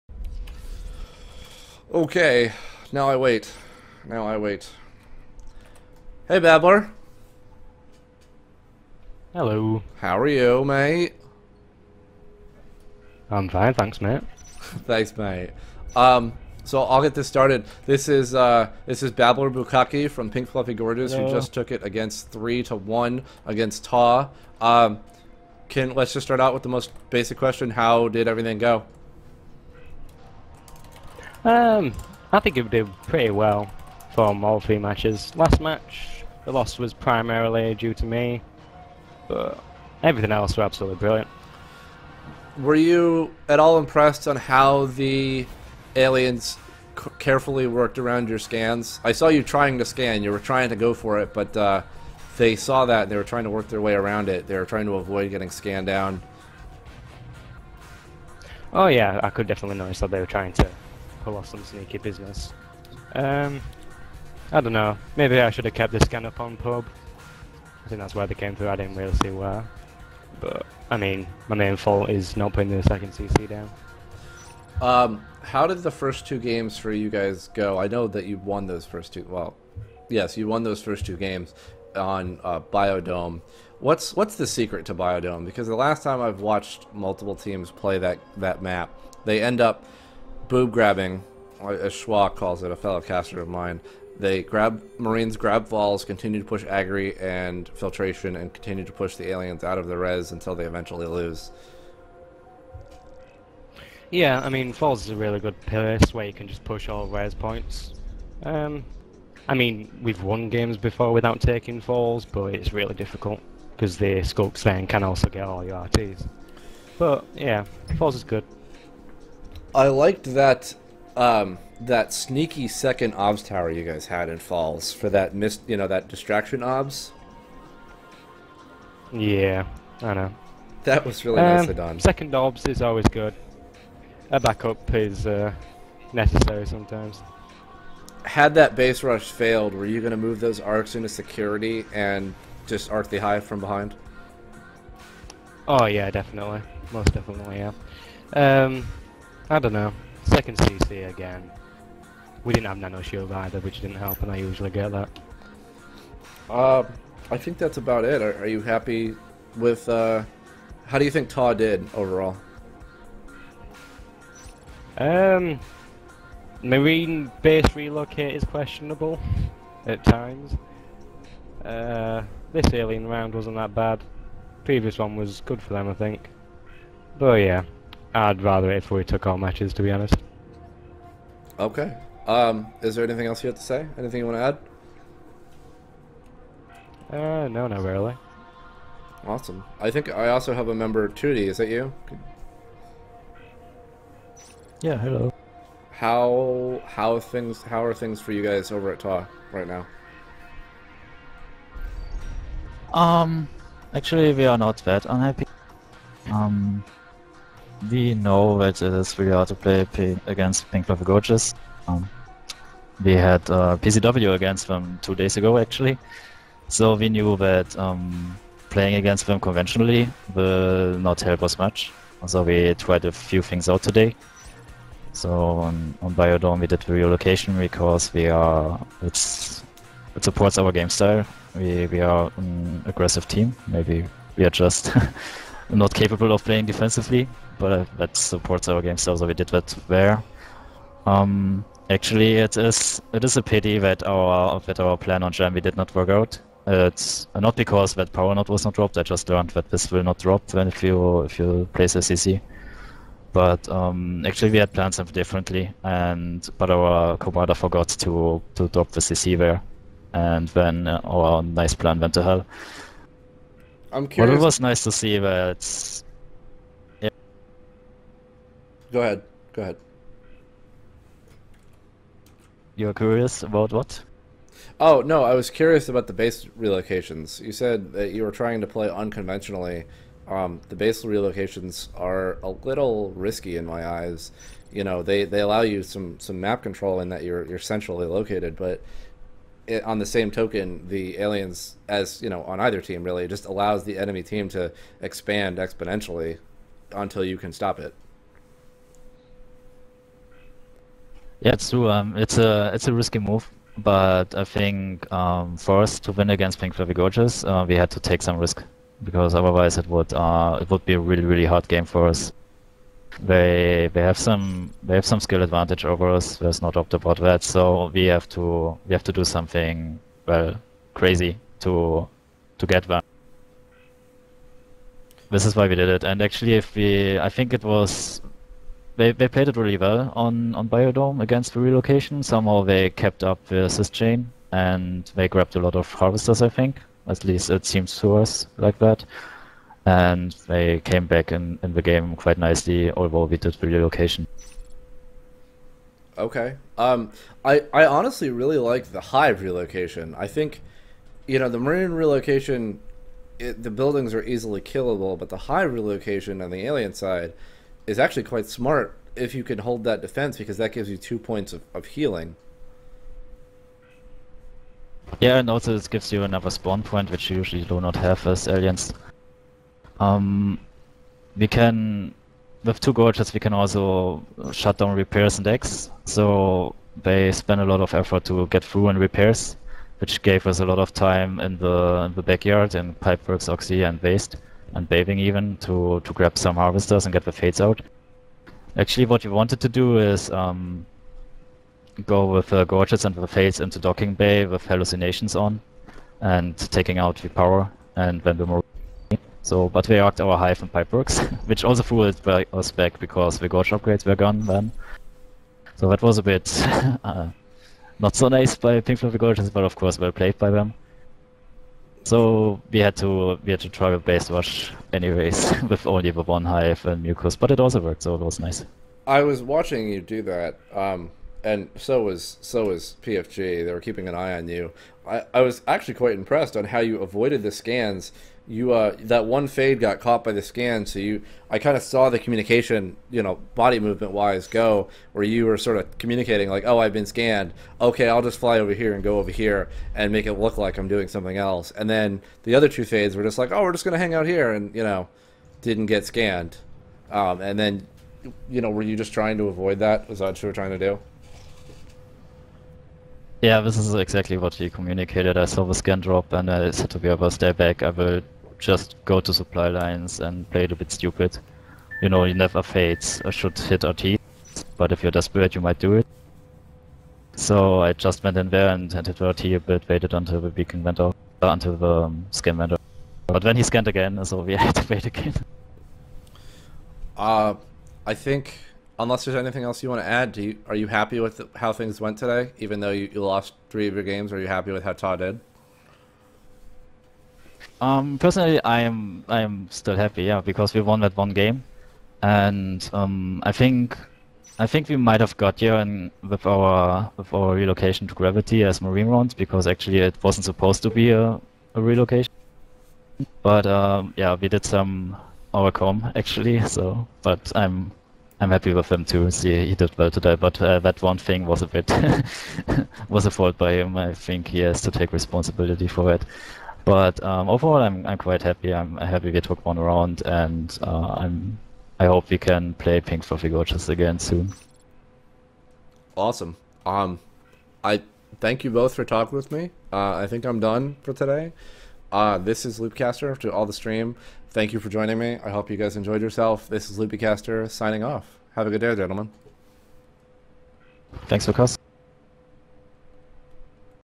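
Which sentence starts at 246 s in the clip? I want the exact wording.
It's uh, not because that power node was not dropped.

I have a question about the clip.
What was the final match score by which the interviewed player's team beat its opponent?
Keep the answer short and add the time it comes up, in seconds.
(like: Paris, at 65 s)
3 to 1, at 22 s.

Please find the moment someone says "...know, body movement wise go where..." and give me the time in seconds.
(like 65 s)
433 s.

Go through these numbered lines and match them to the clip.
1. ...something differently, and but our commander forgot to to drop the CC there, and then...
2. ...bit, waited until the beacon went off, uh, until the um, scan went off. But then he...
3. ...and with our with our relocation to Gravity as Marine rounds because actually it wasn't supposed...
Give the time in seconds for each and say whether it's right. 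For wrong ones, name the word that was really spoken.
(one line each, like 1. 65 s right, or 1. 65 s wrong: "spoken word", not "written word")
1. 254 s right
2. 469 s right
3. 495 s right.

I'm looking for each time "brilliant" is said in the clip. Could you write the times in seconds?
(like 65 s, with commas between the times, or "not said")
40 s.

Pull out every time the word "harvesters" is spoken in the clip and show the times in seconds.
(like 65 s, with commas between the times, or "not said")
335 s, 386 s.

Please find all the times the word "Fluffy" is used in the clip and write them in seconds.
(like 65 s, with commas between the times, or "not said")
20 s, 306 s, 408 s.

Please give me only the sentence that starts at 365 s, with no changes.
Yeah, and also this gives you another spawn point, which you usually do not have as aliens.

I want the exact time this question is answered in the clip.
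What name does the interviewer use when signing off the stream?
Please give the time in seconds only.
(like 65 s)
536 s.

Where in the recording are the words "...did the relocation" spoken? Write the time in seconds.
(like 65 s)
343 s.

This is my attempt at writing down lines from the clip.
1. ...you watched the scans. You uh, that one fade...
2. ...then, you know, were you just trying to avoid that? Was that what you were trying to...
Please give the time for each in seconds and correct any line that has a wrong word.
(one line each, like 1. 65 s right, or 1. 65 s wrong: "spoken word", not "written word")
1. 426 s wrong: "avoided", not "watched"
2. 447 s right.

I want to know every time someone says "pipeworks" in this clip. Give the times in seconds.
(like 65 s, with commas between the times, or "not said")
382 s, 400 s.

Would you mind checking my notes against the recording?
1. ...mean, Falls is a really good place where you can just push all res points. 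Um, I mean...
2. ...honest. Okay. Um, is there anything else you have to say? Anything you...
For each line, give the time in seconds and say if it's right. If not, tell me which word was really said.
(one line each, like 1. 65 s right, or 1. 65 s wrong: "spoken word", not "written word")
1. 104 s right
2. 179 s right.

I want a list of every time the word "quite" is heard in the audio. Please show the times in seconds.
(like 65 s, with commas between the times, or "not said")
342 s, 358 s, 425 s, 518 s.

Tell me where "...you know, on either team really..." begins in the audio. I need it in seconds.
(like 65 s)
292 s.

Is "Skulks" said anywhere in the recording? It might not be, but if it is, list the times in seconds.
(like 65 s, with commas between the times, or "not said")
114 s.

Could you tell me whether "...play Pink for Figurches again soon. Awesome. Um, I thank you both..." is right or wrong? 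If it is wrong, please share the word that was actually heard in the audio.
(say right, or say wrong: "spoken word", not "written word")
right.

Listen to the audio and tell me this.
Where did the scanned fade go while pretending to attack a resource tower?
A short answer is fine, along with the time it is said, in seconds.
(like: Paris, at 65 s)
Supply lines, at 459 s.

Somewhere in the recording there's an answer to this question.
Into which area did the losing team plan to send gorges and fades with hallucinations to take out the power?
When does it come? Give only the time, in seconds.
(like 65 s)
393 s.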